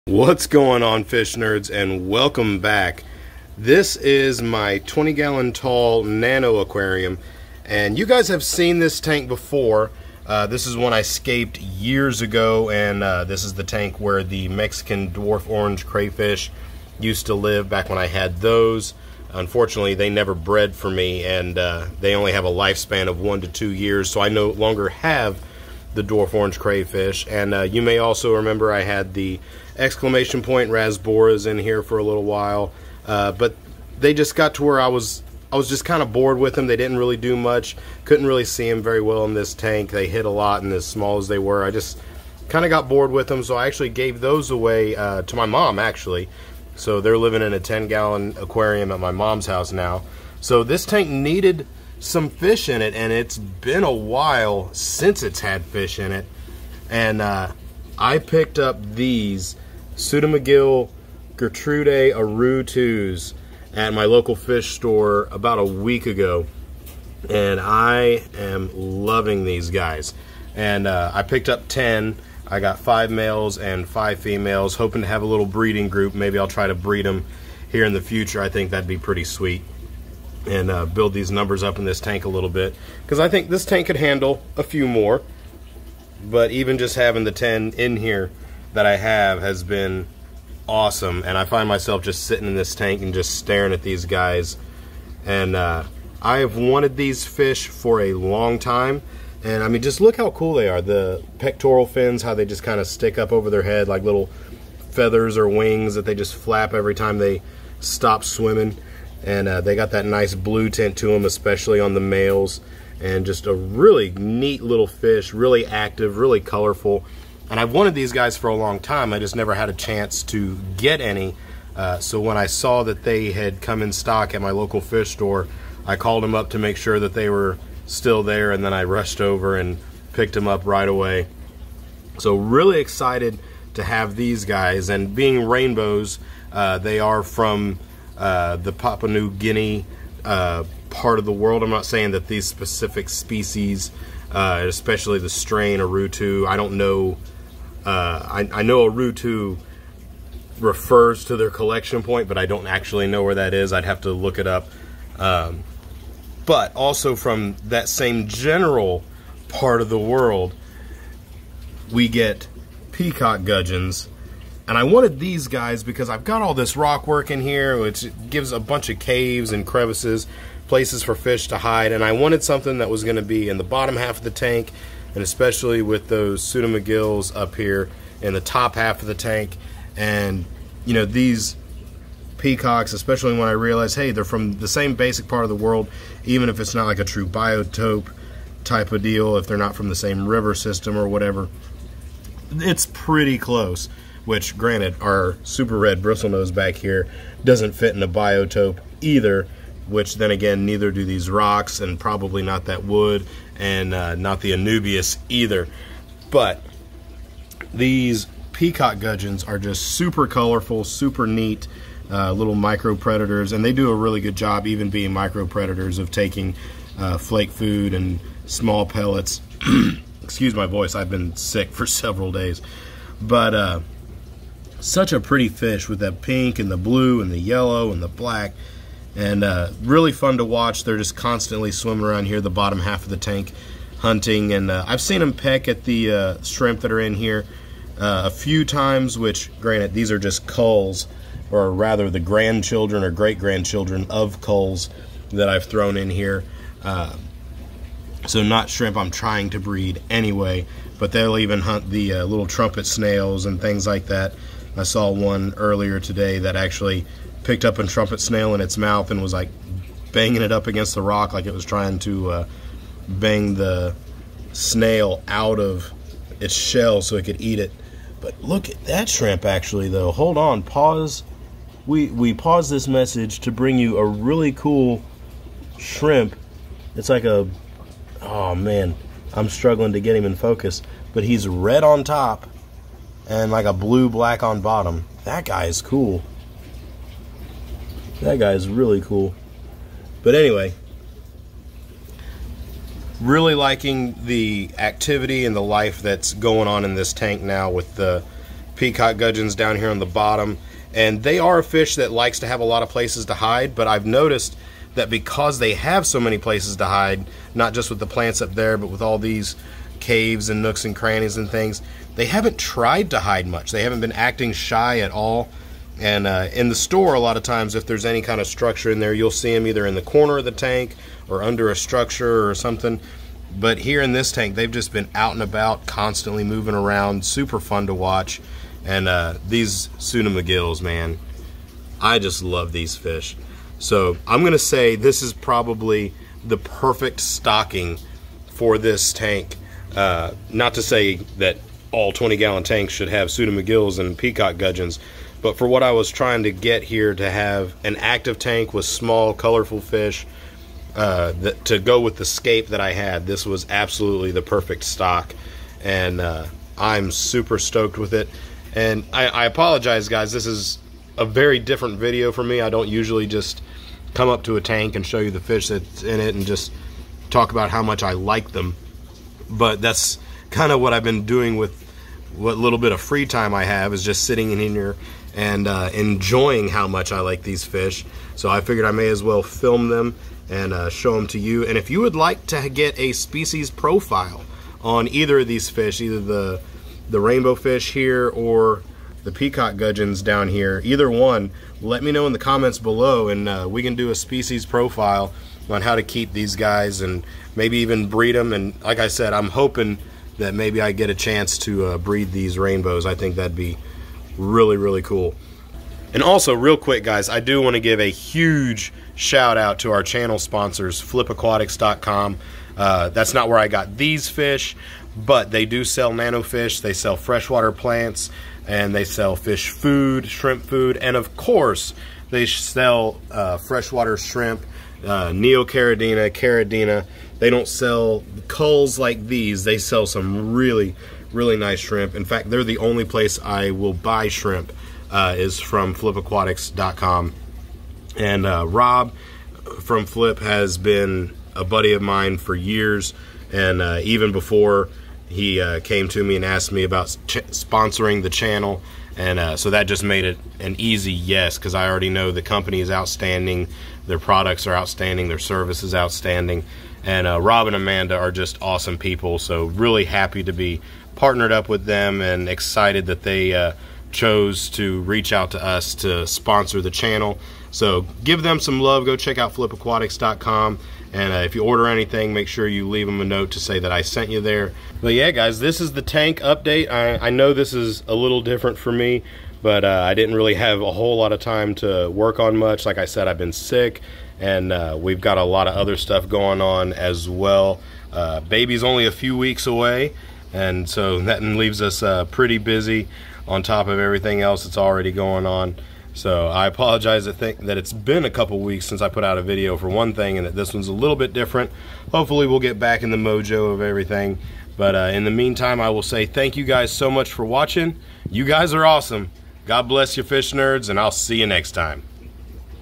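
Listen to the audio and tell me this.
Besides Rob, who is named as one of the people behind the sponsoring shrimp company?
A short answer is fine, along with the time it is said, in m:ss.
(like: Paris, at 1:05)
Amanda, at 7:37.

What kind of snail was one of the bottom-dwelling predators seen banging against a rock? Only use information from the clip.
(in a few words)
trumpet snail.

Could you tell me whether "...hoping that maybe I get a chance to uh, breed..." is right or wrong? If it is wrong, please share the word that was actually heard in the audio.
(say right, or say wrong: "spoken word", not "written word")
right.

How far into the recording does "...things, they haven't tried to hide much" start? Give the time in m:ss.
5:11.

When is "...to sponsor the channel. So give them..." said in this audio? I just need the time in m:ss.
7:45.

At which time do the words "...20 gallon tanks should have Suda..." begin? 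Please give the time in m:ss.
5:42.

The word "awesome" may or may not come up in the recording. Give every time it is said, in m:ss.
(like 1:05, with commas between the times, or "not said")
1:30, 7:38, 8:28.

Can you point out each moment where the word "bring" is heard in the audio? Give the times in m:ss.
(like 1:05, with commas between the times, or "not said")
4:33.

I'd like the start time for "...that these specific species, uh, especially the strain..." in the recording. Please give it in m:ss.
2:22.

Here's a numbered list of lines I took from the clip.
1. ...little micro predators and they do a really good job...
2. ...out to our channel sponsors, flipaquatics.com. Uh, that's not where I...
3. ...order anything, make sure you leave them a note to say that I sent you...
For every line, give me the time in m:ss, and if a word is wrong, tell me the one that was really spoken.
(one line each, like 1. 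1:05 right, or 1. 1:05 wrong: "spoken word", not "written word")
1. 3:32 right
2. 6:49 right
3. 7:51 right.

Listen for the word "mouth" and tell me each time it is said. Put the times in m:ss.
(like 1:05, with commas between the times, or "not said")
4:18.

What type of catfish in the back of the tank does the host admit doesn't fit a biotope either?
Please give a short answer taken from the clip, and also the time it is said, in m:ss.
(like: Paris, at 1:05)
super red bristlenose, at 3:15.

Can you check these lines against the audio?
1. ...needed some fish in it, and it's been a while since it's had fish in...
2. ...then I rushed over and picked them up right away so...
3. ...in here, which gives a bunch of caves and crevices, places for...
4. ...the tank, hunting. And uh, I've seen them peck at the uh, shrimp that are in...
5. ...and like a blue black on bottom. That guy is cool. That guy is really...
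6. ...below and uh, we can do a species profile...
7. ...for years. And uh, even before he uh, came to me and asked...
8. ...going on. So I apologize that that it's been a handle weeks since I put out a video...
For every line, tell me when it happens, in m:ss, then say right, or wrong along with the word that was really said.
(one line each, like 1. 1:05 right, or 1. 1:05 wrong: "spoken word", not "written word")
1. 0:51 right
2. 2:08 right
3. 2:47 right
4. 3:53 right
5. 4:43 right
6. 6:32 right
7. 7:22 right
8. 8:15 wrong: "couple", not "handle".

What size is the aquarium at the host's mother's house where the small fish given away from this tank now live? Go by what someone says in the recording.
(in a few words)
10 gallon.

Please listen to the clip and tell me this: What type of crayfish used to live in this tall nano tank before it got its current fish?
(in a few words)
Mexican dwarf orange crayfish.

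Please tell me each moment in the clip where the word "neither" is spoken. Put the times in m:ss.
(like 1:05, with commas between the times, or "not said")
3:20.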